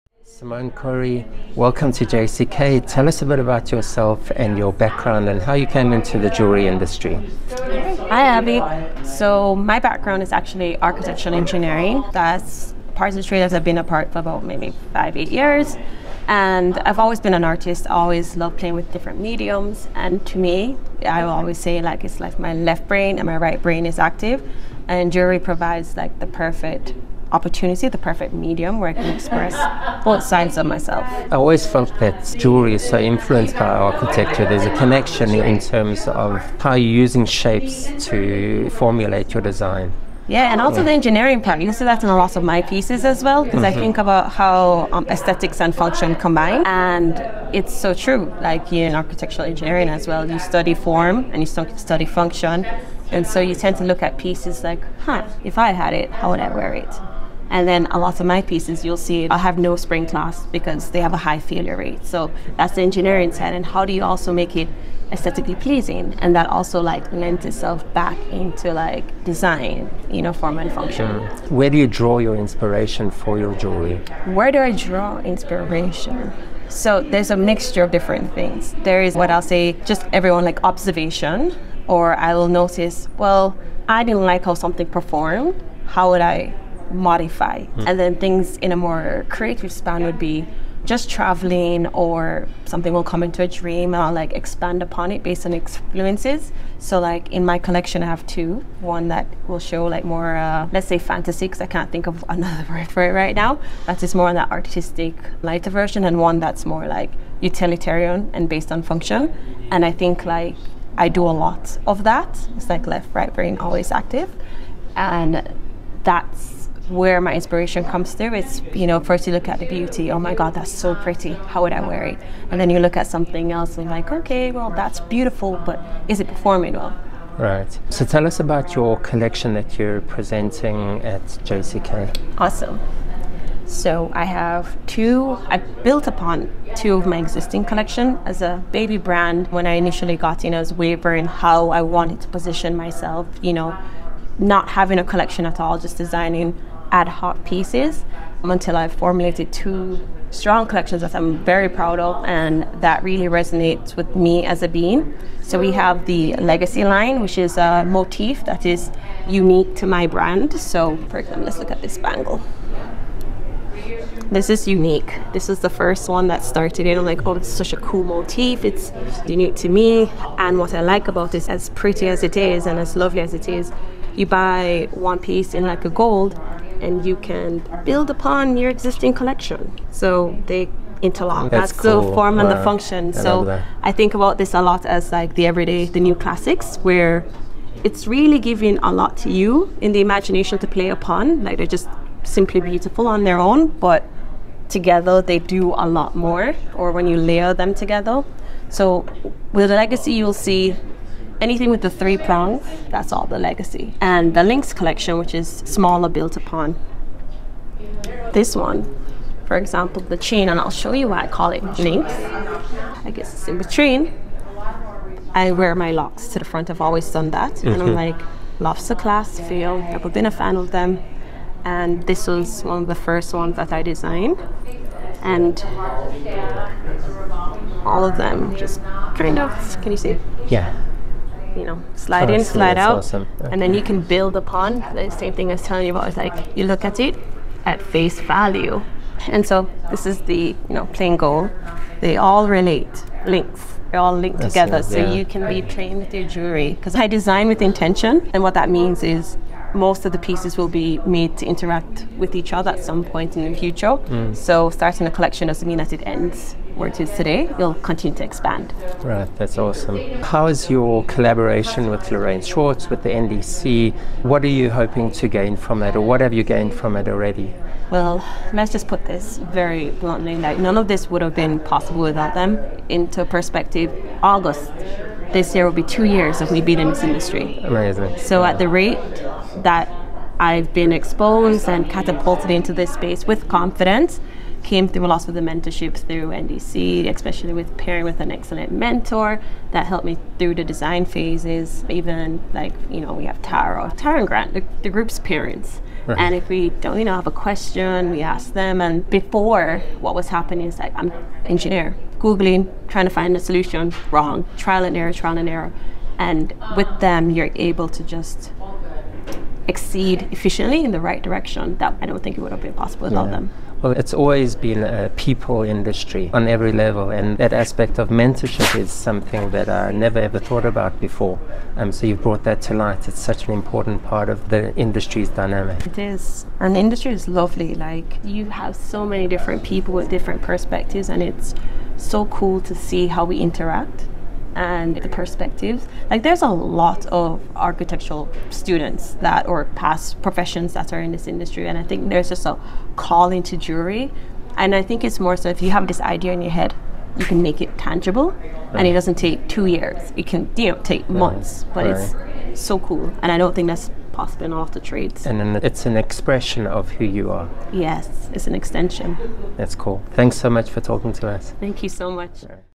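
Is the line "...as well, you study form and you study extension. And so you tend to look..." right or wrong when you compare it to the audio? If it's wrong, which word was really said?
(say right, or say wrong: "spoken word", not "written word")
wrong: "function", not "extension".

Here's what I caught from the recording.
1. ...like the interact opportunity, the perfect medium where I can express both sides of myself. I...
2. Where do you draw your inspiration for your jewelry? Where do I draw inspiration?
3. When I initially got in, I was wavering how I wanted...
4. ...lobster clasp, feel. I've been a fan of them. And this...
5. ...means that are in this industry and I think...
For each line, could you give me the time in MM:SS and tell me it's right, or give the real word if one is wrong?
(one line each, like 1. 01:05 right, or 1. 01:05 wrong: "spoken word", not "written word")
1. 00:25 wrong: "perfect", not "interact"
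2. 01:11 right
3. 02:19 right
4. 03:38 right
5. 05:40 wrong: "professions", not "means".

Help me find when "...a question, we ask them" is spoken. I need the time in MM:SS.
04:57.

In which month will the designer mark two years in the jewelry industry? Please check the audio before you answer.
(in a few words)
August.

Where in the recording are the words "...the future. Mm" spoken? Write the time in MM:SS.
04:13.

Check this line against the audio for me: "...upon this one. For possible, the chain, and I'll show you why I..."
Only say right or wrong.
wrong.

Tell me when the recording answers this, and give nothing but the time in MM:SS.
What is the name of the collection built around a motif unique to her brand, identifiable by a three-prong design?
02:36.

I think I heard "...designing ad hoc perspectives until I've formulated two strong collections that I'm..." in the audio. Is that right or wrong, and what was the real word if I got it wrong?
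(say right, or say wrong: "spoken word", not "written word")
wrong: "pieces", not "perspectives".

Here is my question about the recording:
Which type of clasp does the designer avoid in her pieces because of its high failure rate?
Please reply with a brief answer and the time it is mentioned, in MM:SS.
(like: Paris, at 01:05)
Spring clasp, at 00:59.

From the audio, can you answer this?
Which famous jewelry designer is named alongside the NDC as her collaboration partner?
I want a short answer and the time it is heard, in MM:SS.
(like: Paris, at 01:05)
Lorraine Schwartz, at 04:22.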